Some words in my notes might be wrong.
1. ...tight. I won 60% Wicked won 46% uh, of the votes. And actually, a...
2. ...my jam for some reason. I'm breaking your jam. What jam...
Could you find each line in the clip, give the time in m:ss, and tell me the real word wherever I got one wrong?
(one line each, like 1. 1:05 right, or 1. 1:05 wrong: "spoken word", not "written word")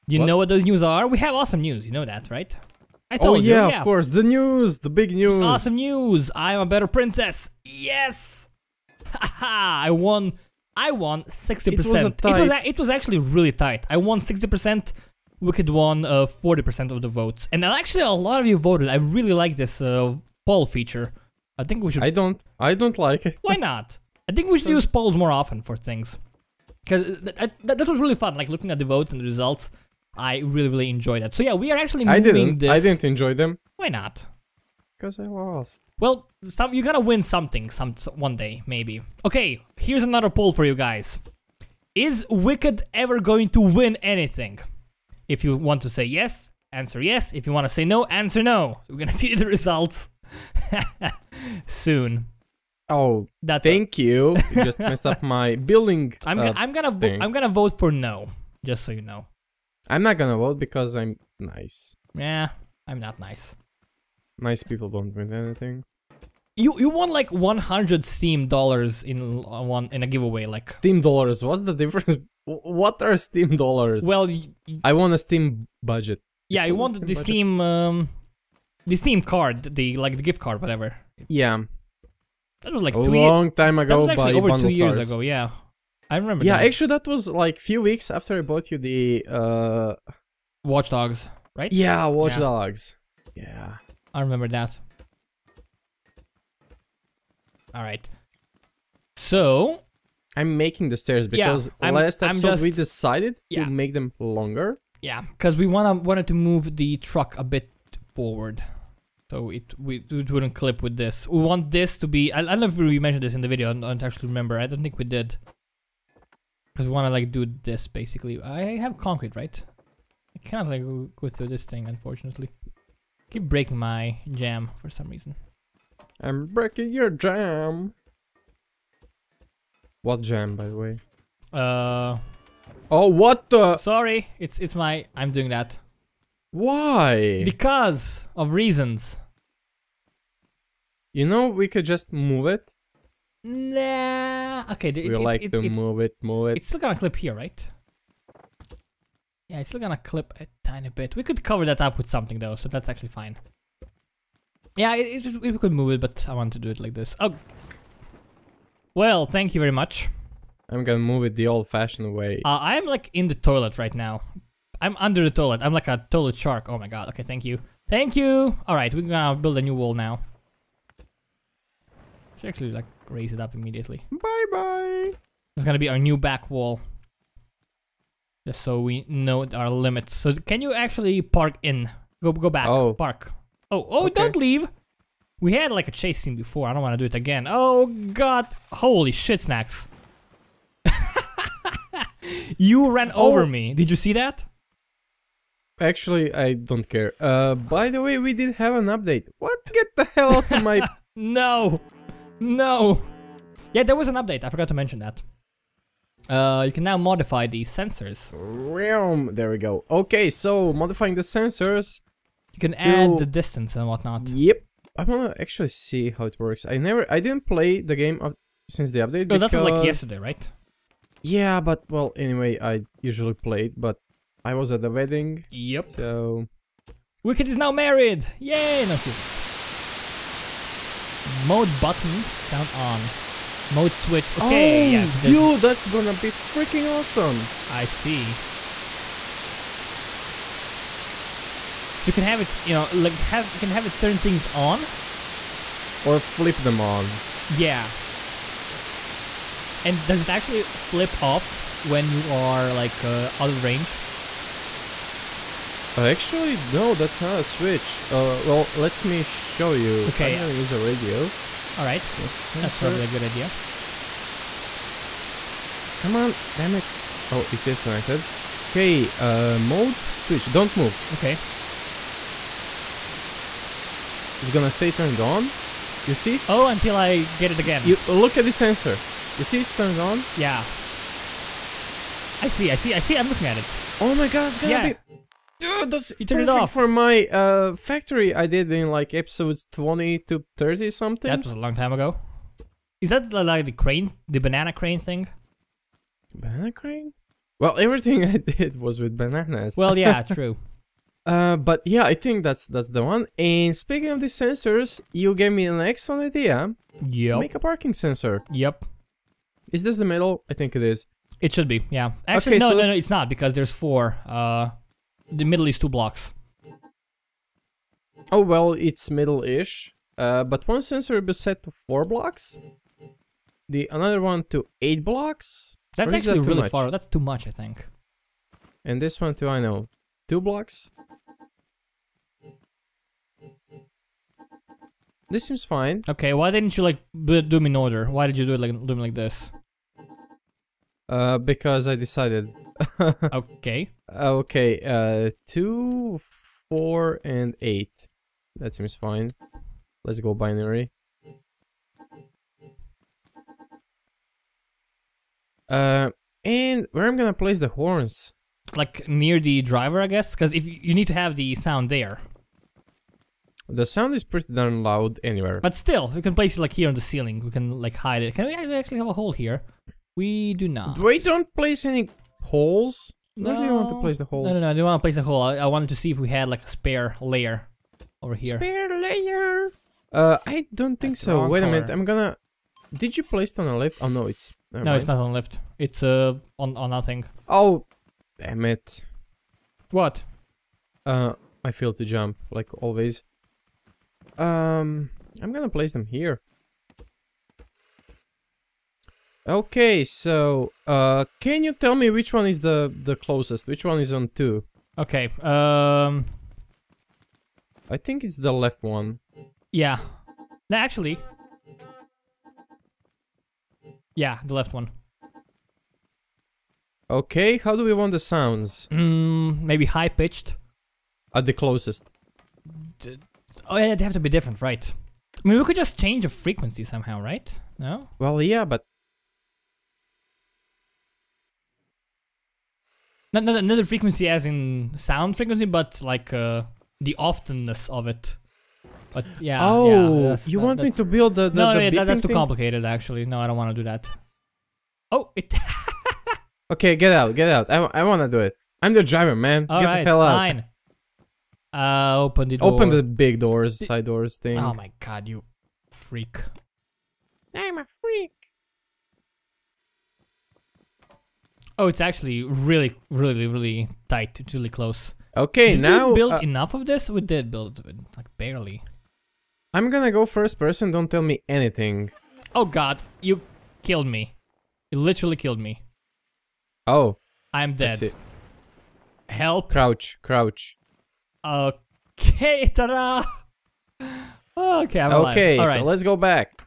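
1. 0:13 wrong: "40", not "46"
2. 2:03 right.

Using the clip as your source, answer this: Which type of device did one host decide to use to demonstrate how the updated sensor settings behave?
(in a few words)
A radio.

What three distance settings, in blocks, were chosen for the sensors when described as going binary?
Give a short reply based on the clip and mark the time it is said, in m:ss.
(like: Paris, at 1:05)
2, 4 and 8, at 5:45.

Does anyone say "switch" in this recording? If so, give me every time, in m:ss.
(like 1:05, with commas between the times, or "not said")
3:53, 4:17, 4:30.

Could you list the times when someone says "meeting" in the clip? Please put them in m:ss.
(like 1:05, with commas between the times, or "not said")
not said.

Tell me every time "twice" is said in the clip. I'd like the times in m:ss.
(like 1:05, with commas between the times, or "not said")
not said.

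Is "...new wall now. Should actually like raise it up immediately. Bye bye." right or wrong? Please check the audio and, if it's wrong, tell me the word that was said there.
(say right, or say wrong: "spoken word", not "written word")
right.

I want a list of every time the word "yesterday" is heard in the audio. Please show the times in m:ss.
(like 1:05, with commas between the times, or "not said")
3:39.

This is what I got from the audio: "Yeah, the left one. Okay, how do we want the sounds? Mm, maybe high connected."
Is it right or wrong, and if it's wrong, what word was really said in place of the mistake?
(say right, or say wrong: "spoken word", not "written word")
wrong: "pitched", not "connected".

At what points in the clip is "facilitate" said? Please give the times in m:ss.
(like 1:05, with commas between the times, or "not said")
not said.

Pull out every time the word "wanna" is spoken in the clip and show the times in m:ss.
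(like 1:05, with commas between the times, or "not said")
1:45, 3:35.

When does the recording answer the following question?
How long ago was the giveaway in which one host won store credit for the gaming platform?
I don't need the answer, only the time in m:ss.
1:24.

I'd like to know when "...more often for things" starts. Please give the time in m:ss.
0:25.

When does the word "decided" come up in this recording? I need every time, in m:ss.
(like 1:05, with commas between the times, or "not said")
1:42, 5:41.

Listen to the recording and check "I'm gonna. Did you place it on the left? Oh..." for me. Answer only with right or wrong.
right.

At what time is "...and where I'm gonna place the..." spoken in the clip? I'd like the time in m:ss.
5:56.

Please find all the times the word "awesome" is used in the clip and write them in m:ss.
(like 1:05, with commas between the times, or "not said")
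0:01, 0:05, 3:56.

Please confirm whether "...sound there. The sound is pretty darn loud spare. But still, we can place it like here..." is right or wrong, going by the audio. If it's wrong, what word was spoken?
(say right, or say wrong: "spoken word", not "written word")
wrong: "anywhere", not "spare".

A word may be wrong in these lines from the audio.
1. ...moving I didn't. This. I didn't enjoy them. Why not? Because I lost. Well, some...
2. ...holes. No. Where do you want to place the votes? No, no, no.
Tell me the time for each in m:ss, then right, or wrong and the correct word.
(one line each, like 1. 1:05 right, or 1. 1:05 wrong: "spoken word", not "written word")
1. 0:32 right
2. 6:12 wrong: "holes", not "votes".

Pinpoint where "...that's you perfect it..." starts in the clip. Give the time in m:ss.
4:45.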